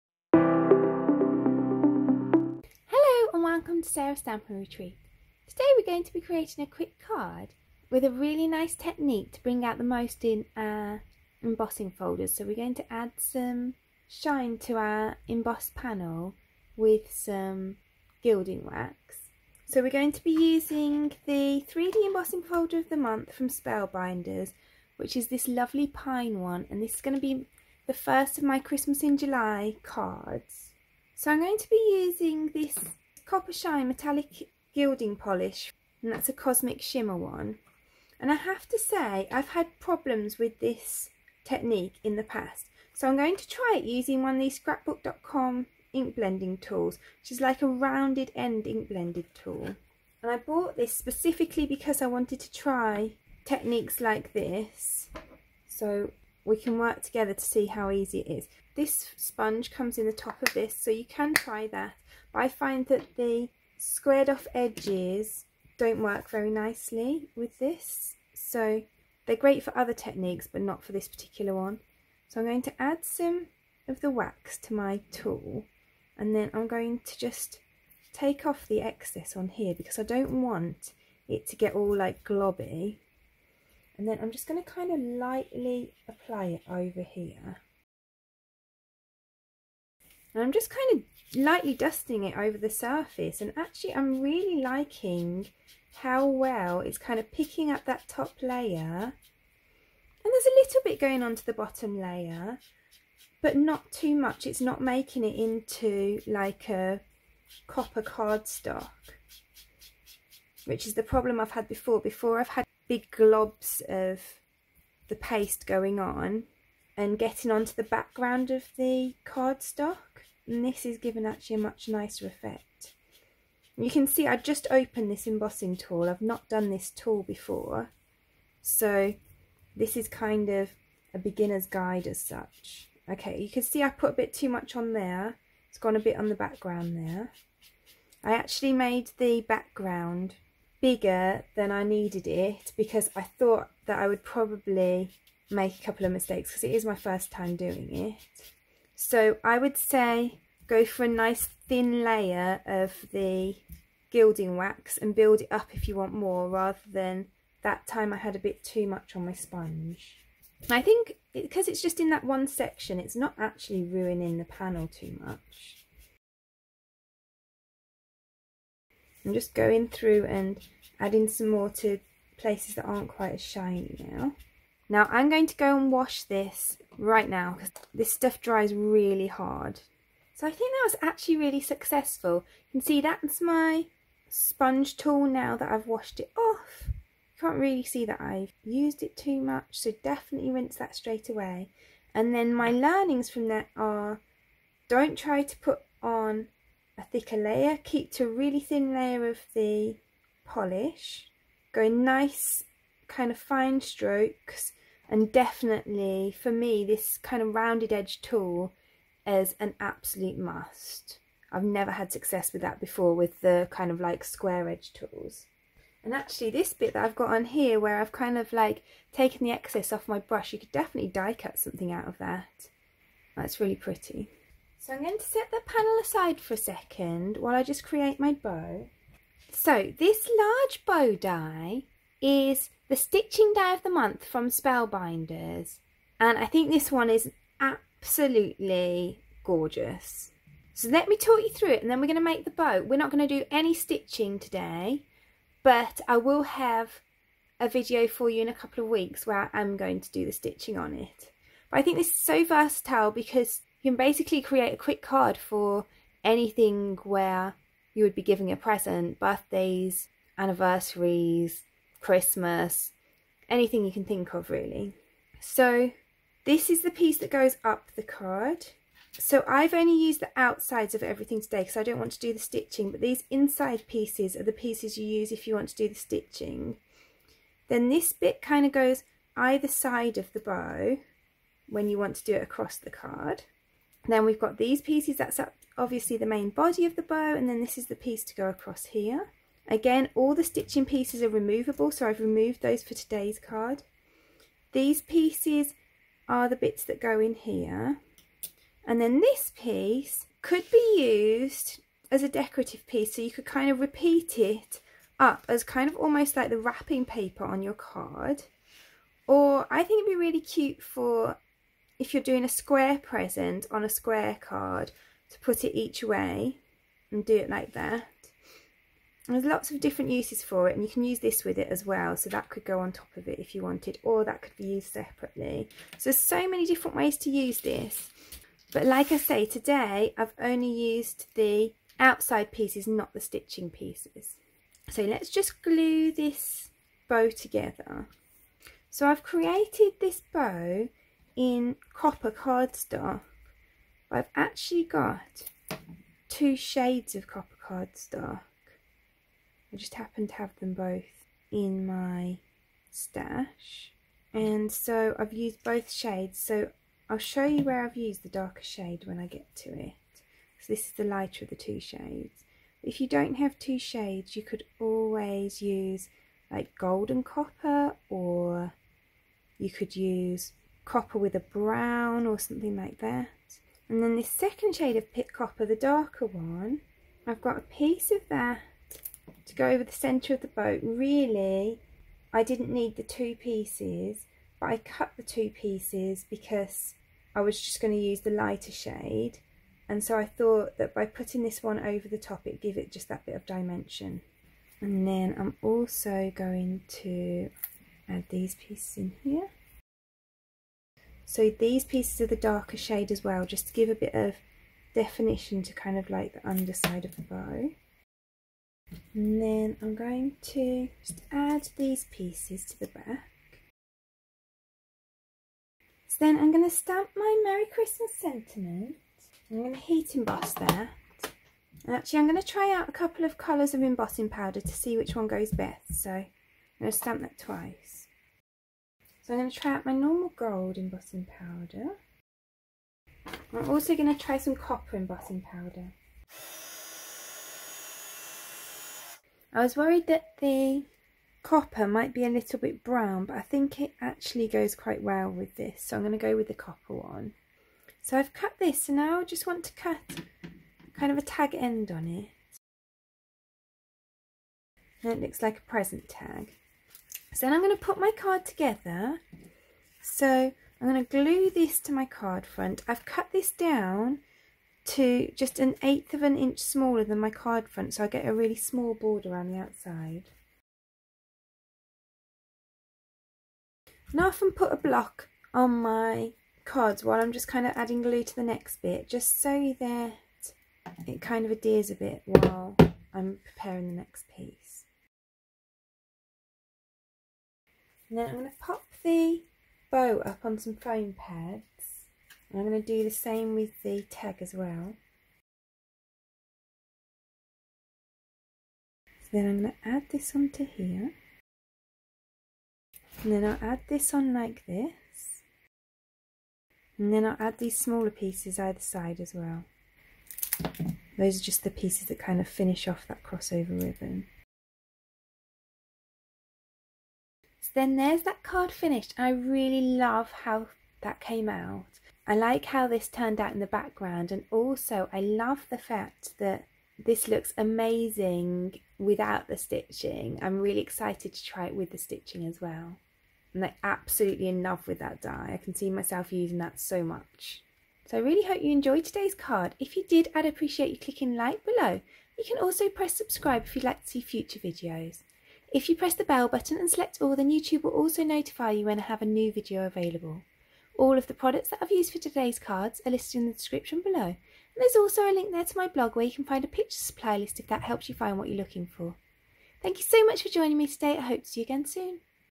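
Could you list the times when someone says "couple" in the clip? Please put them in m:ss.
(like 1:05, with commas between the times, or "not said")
2:25, 4:08, 7:02.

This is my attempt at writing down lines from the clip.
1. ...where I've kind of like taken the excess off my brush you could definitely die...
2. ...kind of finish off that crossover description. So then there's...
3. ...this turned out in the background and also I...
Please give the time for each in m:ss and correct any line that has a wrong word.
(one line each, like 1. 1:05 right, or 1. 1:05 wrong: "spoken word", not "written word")
1. 3:37 right
2. 8:32 wrong: "ribbon", not "description"
3. 8:42 right.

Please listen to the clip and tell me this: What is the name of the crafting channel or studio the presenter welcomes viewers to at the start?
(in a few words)
Sarah's Stampin' Retreat.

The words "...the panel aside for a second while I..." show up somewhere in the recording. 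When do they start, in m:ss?
3:45.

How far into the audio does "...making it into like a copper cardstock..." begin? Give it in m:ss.
1:44.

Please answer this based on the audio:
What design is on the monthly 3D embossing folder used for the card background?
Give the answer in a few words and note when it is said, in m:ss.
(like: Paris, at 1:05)
pine, at 0:25.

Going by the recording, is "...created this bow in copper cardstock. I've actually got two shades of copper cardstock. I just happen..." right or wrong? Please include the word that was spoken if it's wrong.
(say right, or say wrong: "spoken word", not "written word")
right.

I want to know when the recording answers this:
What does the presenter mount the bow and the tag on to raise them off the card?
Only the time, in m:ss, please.
8:10.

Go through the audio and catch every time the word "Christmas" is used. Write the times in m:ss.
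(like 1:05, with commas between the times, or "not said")
0:28, 4:22, 6:57.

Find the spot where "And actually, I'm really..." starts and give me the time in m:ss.
1:33.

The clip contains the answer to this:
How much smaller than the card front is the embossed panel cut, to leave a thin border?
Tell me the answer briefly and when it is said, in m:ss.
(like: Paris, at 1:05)
an eighth of an inch, at 7:45.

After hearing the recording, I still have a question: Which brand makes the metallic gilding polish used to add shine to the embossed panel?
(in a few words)
Cosmic Shimmer.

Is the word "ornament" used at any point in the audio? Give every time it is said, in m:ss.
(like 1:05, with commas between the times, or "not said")
not said.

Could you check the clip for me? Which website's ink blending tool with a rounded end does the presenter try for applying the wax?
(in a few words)
scrapbook.com.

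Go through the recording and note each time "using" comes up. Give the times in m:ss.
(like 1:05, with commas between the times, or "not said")
0:20, 0:32, 0:43, 8:56.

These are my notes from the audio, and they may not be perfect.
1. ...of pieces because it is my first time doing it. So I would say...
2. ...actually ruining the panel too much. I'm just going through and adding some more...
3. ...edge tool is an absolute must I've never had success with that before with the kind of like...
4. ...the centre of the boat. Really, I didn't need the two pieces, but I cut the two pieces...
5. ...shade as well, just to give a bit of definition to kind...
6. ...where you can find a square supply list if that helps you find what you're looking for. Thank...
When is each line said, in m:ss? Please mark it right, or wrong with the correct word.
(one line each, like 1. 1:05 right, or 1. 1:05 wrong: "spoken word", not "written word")
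1. 2:26 wrong: "mistakes", not "pieces"
2. 2:43 right
3. 3:27 right
4. 6:19 right
5. 6:42 right
6. 9:16 wrong: "picture", not "square".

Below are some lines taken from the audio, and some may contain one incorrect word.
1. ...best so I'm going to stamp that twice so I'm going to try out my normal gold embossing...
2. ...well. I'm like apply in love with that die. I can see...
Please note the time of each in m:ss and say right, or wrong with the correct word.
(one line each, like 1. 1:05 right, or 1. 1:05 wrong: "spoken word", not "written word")
1. 7:05 right
2. 8:52 wrong: "absolutely", not "apply".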